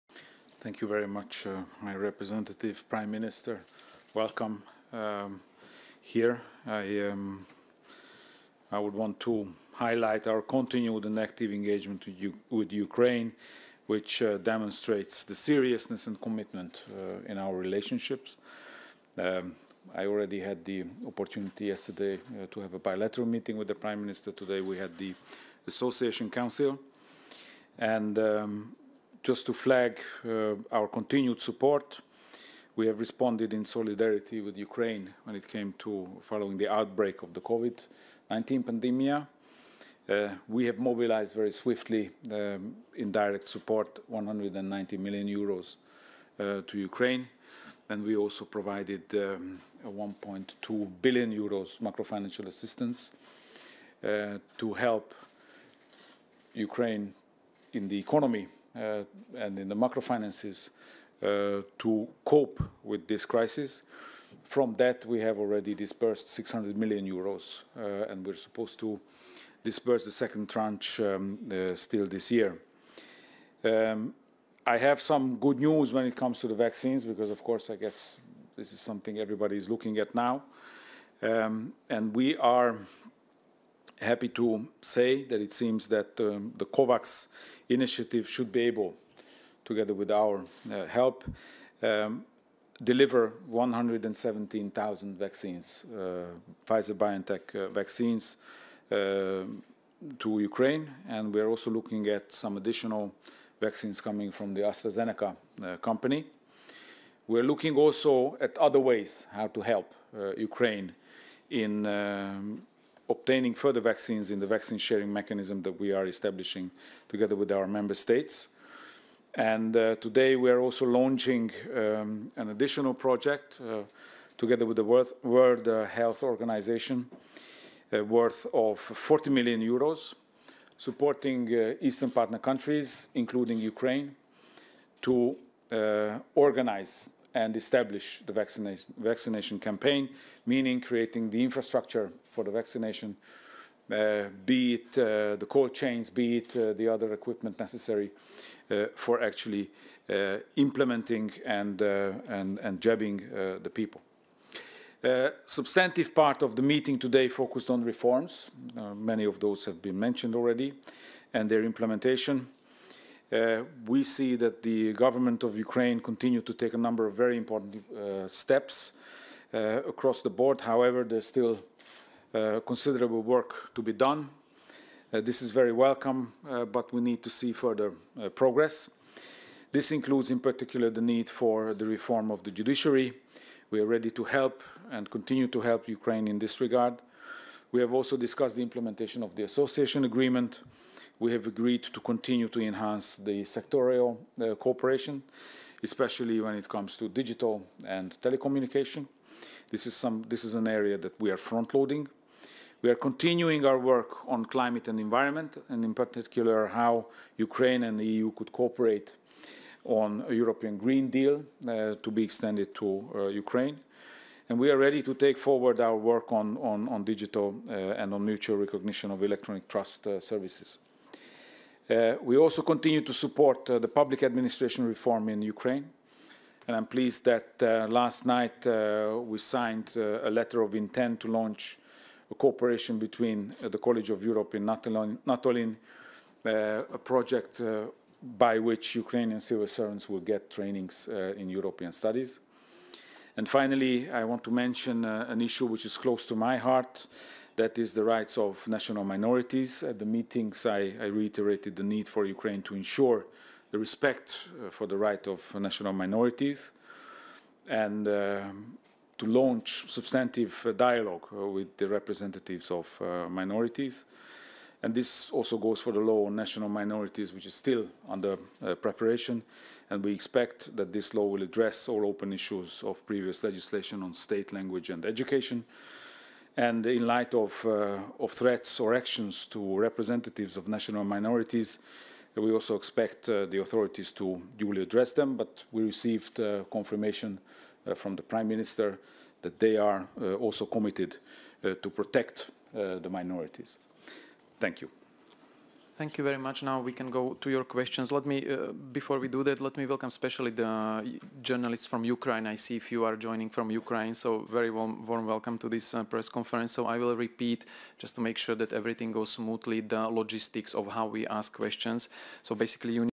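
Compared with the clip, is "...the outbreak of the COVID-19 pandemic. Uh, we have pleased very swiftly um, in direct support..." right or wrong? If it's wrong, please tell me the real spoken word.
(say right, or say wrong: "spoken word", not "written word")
wrong: "mobilized", not "pleased".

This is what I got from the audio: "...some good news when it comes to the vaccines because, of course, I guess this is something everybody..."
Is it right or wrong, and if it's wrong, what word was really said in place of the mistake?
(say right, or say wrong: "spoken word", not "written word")
right.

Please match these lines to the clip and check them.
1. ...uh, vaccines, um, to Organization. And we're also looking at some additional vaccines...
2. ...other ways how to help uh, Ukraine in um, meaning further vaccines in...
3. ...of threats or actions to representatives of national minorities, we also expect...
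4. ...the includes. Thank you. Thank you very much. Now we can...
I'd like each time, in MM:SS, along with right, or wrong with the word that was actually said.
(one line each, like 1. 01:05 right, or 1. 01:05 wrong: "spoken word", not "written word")
1. 01:37 wrong: "Ukraine", not "Organization"
2. 01:48 wrong: "obtaining", not "meaning"
3. 04:38 right
4. 04:52 wrong: "minorities", not "includes".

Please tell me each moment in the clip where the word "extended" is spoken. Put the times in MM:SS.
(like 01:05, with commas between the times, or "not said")
03:32.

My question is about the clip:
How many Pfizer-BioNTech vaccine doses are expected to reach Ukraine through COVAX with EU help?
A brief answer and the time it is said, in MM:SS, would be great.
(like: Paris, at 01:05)
117,000, at 01:33.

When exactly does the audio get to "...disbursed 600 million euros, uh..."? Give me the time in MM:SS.
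01:05.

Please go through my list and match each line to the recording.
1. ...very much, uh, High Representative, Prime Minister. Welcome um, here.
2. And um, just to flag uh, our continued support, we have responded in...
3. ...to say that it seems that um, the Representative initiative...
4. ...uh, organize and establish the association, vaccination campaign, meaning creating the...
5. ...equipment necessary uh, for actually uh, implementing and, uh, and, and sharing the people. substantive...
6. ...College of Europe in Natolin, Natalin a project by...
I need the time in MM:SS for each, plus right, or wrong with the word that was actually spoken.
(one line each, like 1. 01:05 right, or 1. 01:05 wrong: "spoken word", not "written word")
1. 00:00 right
2. 00:27 right
3. 01:24 wrong: "COVAX", not "Representative"
4. 02:15 wrong: "vaccination", not "association"
5. 02:27 wrong: "jabbing", not "sharing"
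6. 03:53 right.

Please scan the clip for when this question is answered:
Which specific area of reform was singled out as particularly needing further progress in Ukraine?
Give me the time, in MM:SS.
03:02.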